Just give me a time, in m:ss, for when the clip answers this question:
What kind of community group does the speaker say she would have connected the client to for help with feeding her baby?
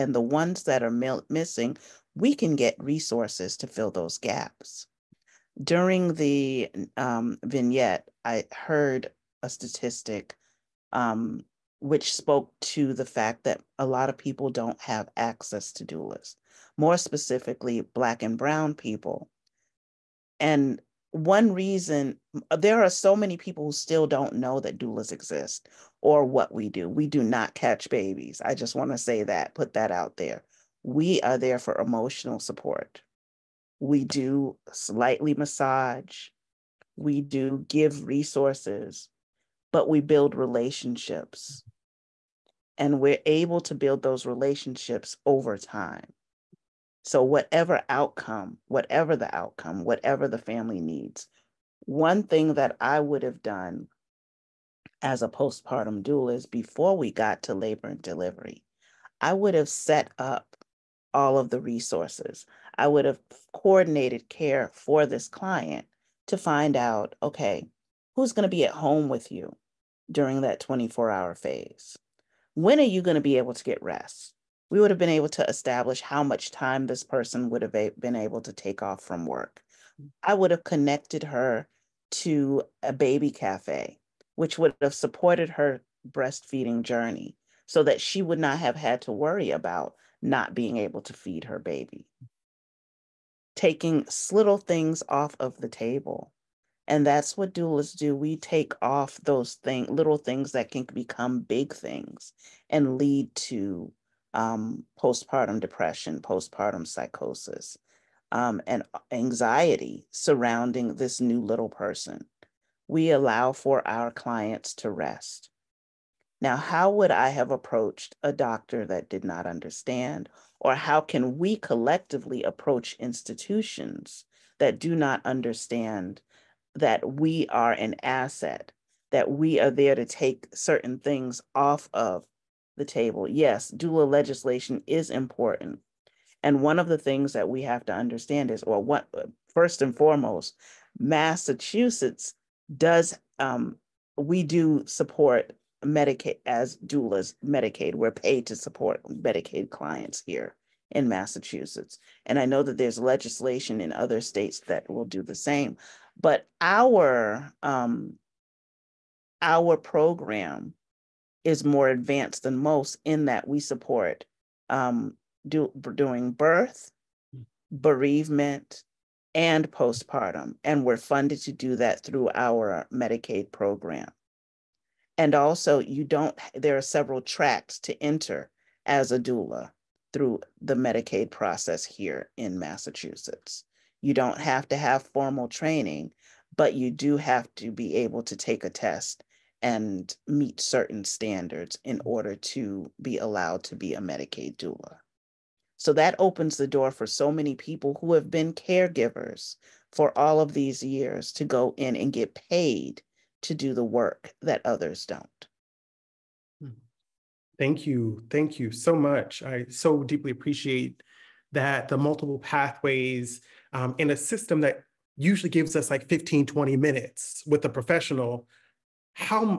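1:22.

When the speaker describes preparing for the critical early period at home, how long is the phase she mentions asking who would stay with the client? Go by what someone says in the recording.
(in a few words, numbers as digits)
24 hours.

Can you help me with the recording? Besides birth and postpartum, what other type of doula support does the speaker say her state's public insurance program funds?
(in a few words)
bereavement.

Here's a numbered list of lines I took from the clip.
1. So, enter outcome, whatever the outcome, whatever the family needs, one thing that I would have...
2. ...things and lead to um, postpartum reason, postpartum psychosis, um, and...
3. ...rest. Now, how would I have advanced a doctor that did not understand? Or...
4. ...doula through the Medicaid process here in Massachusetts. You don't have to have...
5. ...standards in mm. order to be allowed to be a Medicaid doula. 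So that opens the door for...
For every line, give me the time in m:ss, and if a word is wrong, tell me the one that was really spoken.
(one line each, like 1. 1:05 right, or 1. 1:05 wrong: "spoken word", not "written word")
1. 0:47 wrong: "whatever", not "enter"
2. 1:41 wrong: "depression", not "reason"
3. 1:54 wrong: "approached", not "advanced"
4. 2:59 right
5. 3:11 right.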